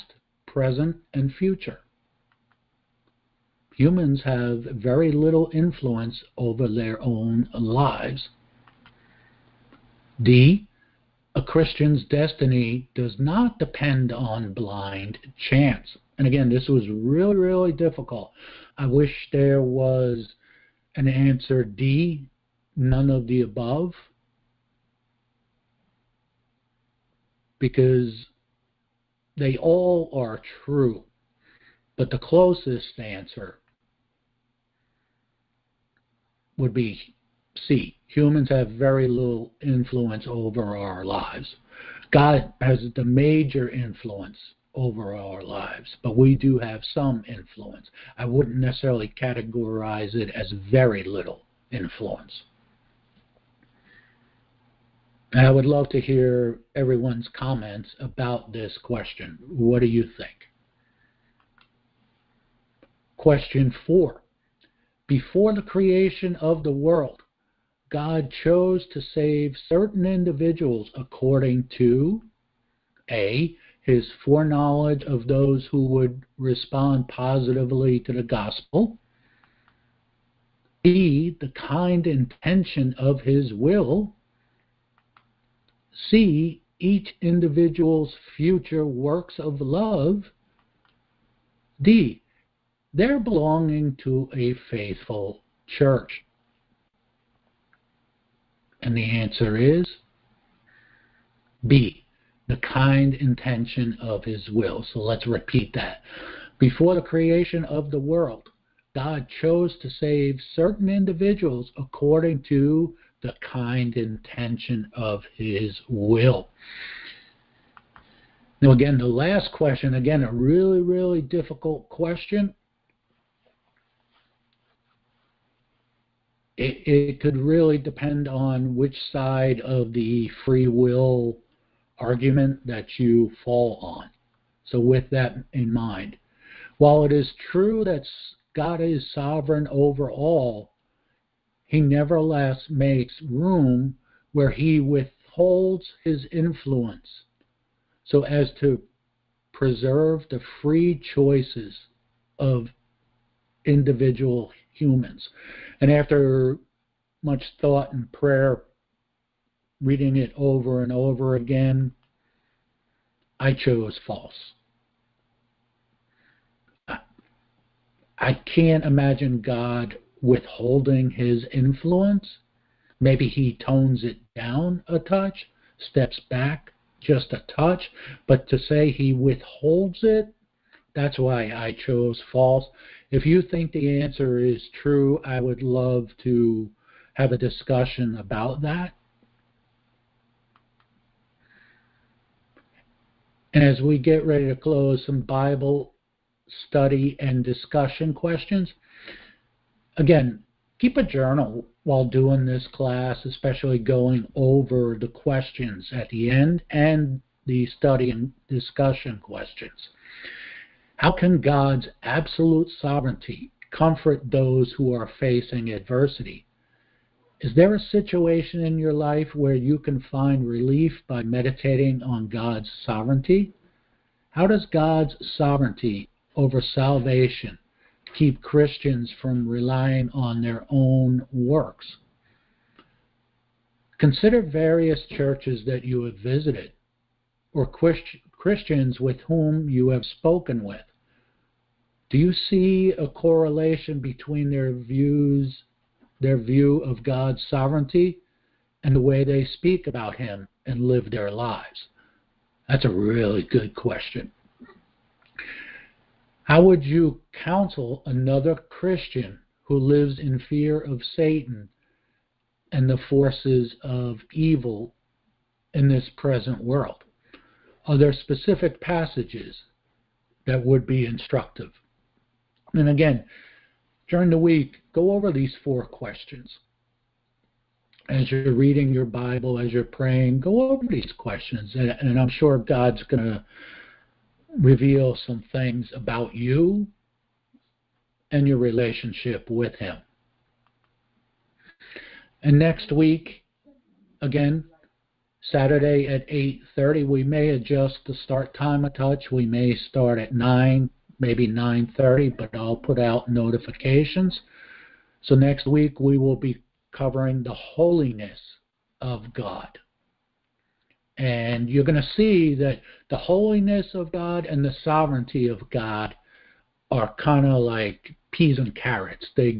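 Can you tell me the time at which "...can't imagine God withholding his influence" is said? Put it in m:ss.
2:48.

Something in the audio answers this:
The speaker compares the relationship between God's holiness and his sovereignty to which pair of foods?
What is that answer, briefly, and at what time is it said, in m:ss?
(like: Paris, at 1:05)
Peas and carrots, at 5:18.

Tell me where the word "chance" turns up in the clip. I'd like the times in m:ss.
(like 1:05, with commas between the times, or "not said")
0:15.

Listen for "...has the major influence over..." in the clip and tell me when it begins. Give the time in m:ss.
0:42.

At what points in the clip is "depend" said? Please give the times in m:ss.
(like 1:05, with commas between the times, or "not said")
0:13, 2:07.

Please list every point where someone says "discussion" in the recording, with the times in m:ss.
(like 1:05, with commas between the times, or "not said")
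3:07, 3:17, 3:28.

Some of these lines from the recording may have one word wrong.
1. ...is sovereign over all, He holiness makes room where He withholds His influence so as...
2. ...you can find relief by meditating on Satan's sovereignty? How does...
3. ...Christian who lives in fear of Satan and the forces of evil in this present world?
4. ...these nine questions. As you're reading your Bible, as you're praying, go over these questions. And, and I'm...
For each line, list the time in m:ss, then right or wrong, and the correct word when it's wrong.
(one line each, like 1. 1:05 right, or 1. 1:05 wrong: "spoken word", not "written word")
1. 2:18 wrong: "nevertheless", not "holiness"
2. 3:39 wrong: "God", not "Satan"
3. 4:18 right
4. 4:35 wrong: "four", not "nine".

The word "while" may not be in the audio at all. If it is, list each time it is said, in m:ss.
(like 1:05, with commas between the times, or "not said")
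2:16, 3:21.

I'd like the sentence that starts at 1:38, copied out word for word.
And the answer is B the kind intention of his will.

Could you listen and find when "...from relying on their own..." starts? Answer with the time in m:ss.
3:49.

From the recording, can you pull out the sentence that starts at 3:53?
Consider various churches that you have visited or Christians with whom you have spoken with.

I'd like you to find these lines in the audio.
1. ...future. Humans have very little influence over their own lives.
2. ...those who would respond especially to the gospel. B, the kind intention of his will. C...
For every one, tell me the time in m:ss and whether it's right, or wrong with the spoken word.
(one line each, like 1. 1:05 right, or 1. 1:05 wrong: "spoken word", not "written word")
1. 0:01 right
2. 1:15 wrong: "positively", not "especially".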